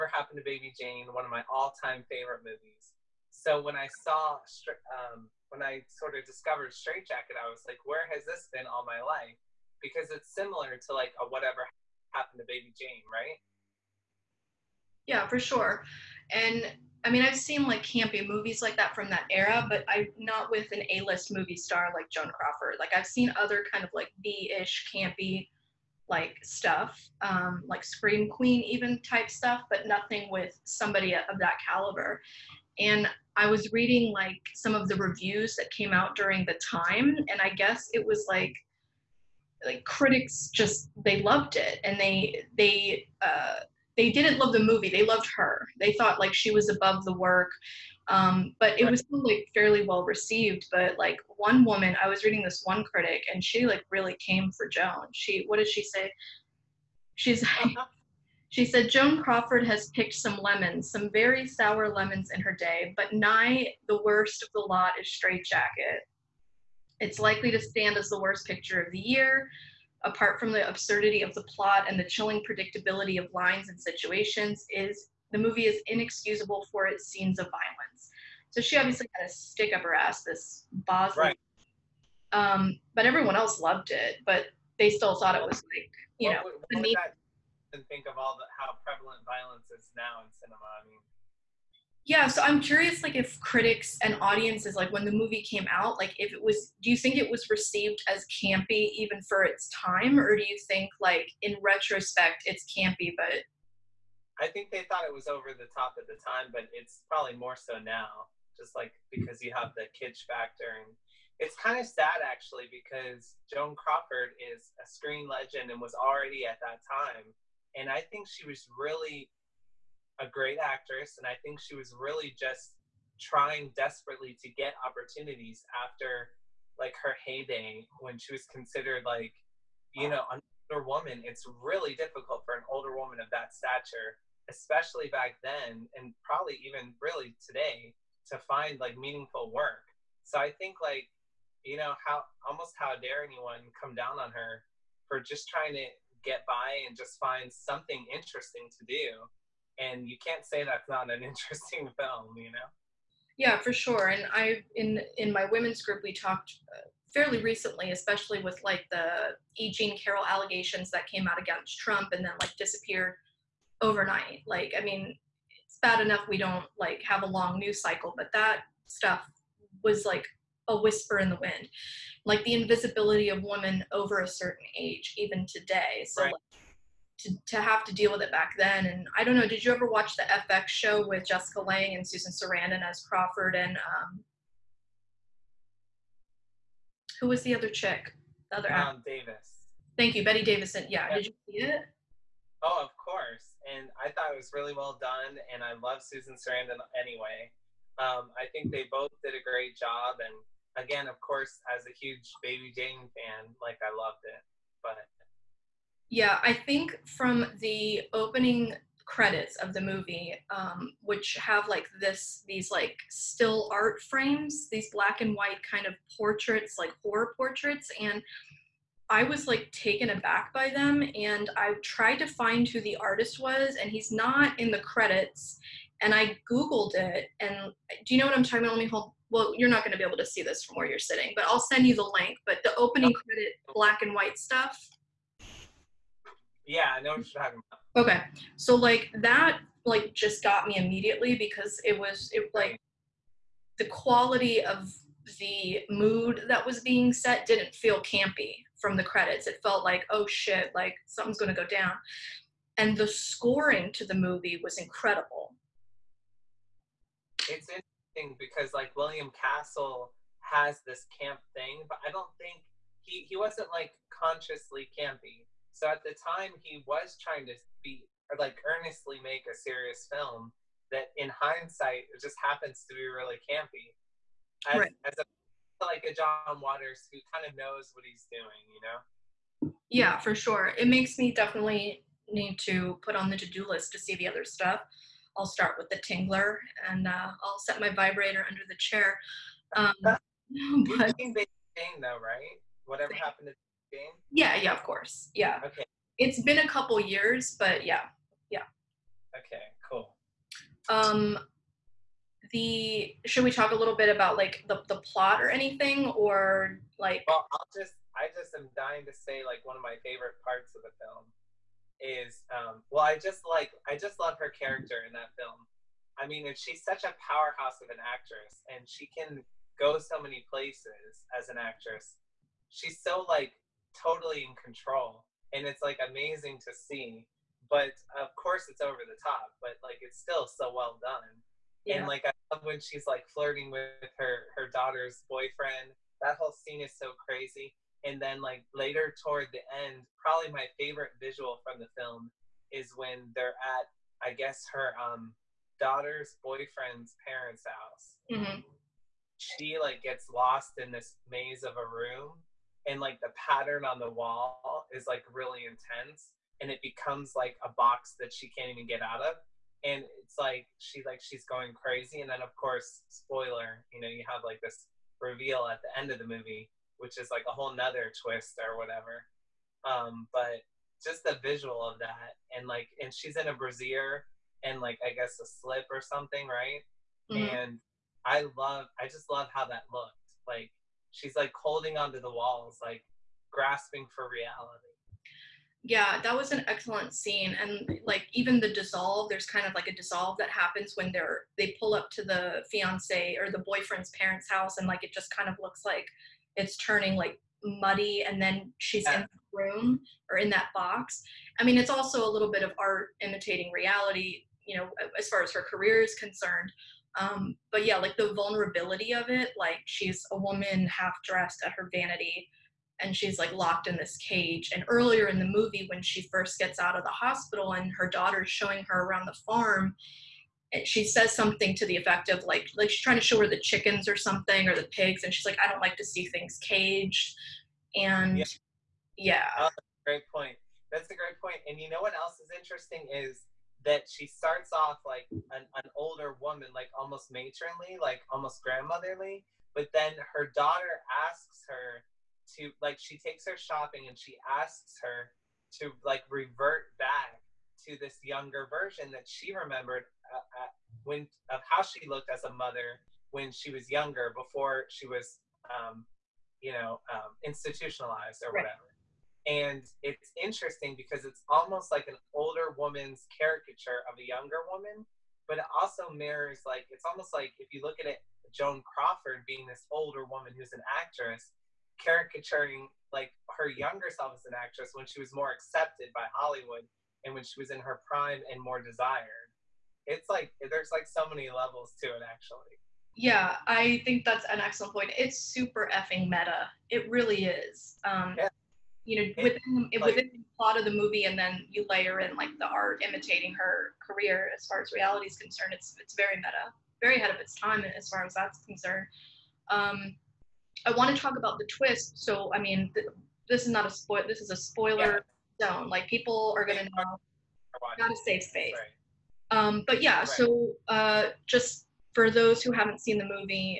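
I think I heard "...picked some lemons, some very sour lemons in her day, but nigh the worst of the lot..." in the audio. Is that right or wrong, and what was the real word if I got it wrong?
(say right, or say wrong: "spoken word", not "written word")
right.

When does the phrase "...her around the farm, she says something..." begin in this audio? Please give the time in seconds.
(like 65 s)
418 s.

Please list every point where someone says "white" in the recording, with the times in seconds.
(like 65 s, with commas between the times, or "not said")
215 s, 234 s.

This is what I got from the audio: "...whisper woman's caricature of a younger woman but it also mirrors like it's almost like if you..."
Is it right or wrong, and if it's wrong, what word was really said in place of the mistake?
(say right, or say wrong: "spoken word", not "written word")
wrong: "older", not "whisper".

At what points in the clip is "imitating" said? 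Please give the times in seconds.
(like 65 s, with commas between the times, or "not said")
403 s, 493 s.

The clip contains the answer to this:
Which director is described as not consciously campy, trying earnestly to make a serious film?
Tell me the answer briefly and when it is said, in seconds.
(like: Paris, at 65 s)
William Castle, at 258 s.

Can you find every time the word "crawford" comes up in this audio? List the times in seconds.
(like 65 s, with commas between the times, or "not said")
22 s, 59 s, 113 s, 183 s, 468 s.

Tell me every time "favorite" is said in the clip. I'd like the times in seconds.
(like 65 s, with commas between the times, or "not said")
2 s, 310 s, 340 s.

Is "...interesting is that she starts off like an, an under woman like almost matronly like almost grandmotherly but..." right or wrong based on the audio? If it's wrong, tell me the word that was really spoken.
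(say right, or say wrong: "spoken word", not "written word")
wrong: "older", not "under".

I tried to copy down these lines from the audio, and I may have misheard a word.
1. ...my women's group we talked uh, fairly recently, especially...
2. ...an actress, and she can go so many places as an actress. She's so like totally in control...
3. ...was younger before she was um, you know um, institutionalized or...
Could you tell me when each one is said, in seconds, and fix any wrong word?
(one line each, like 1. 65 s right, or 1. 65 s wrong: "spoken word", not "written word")
1. 155 s right
2. 317 s right
3. 453 s right.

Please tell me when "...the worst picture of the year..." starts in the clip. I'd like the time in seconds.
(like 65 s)
68 s.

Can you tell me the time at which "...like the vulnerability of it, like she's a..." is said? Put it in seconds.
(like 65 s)
407 s.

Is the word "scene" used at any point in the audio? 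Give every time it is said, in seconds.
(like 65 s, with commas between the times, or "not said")
77 s, 336 s, 387 s.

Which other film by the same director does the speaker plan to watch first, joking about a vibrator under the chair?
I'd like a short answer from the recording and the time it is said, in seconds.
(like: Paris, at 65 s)
The Tingler, at 285 s.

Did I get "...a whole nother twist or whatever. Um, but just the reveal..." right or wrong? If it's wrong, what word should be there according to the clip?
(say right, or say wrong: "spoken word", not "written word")
wrong: "visual", not "reveal".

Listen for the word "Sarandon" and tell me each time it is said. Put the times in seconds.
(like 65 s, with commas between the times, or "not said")
182 s, 196 s.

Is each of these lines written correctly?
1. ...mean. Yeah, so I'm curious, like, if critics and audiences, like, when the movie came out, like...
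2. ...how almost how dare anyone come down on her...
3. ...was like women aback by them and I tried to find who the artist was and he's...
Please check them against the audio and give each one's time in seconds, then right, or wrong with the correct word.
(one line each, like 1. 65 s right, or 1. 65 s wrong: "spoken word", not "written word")
1. 90 s right
2. 142 s right
3. 219 s wrong: "taken", not "women".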